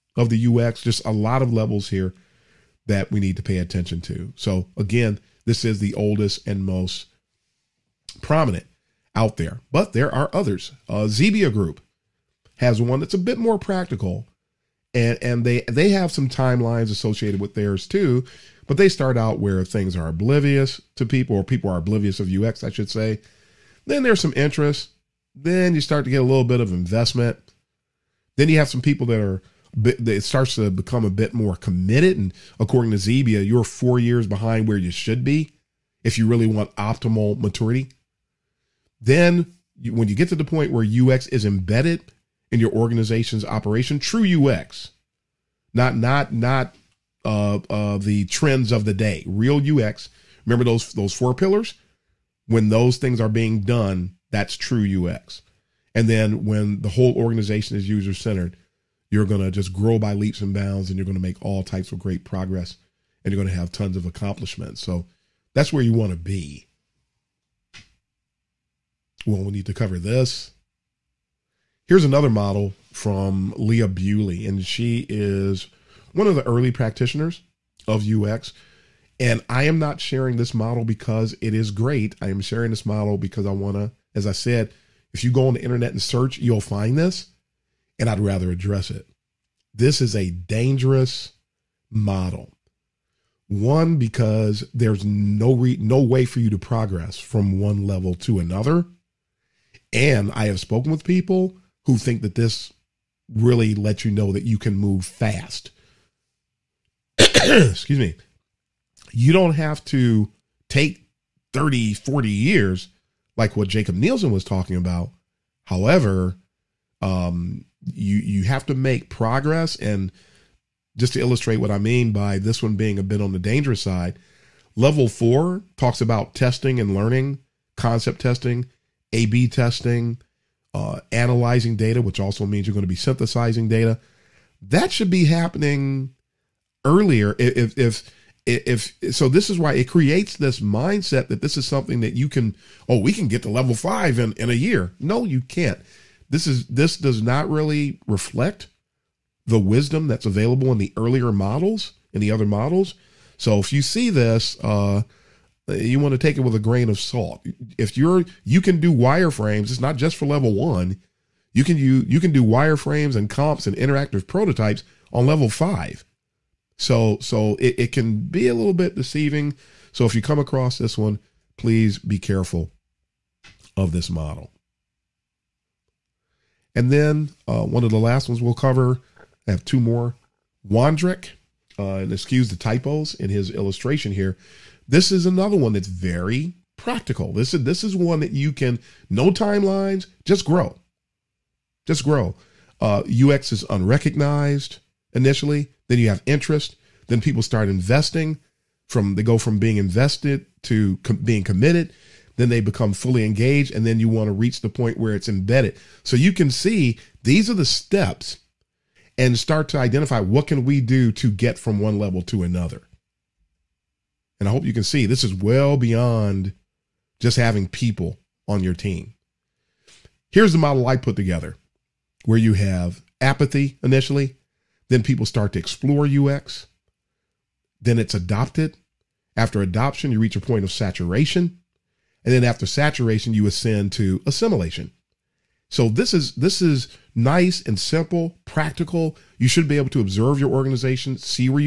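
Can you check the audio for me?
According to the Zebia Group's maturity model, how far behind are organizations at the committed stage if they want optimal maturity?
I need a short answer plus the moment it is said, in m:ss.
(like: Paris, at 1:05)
4 years, at 0:33.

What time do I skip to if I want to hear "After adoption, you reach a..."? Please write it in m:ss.
3:49.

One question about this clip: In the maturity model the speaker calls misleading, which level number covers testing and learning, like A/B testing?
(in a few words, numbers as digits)
Level 4.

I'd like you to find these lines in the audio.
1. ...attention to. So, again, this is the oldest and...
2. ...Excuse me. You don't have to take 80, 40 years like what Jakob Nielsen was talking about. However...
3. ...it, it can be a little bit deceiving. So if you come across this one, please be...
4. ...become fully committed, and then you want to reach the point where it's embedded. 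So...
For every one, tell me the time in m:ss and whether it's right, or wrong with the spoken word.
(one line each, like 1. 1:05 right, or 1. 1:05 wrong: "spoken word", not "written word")
1. 0:03 right
2. 1:47 wrong: "30", not "80"
3. 2:47 right
4. 3:22 wrong: "engaged", not "committed".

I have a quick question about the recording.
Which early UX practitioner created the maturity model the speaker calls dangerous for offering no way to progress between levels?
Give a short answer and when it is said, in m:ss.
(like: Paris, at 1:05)
Leah Buley, at 1:13.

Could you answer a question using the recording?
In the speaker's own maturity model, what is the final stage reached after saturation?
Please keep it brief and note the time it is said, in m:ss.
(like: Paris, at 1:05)
Assimilation, at 3:54.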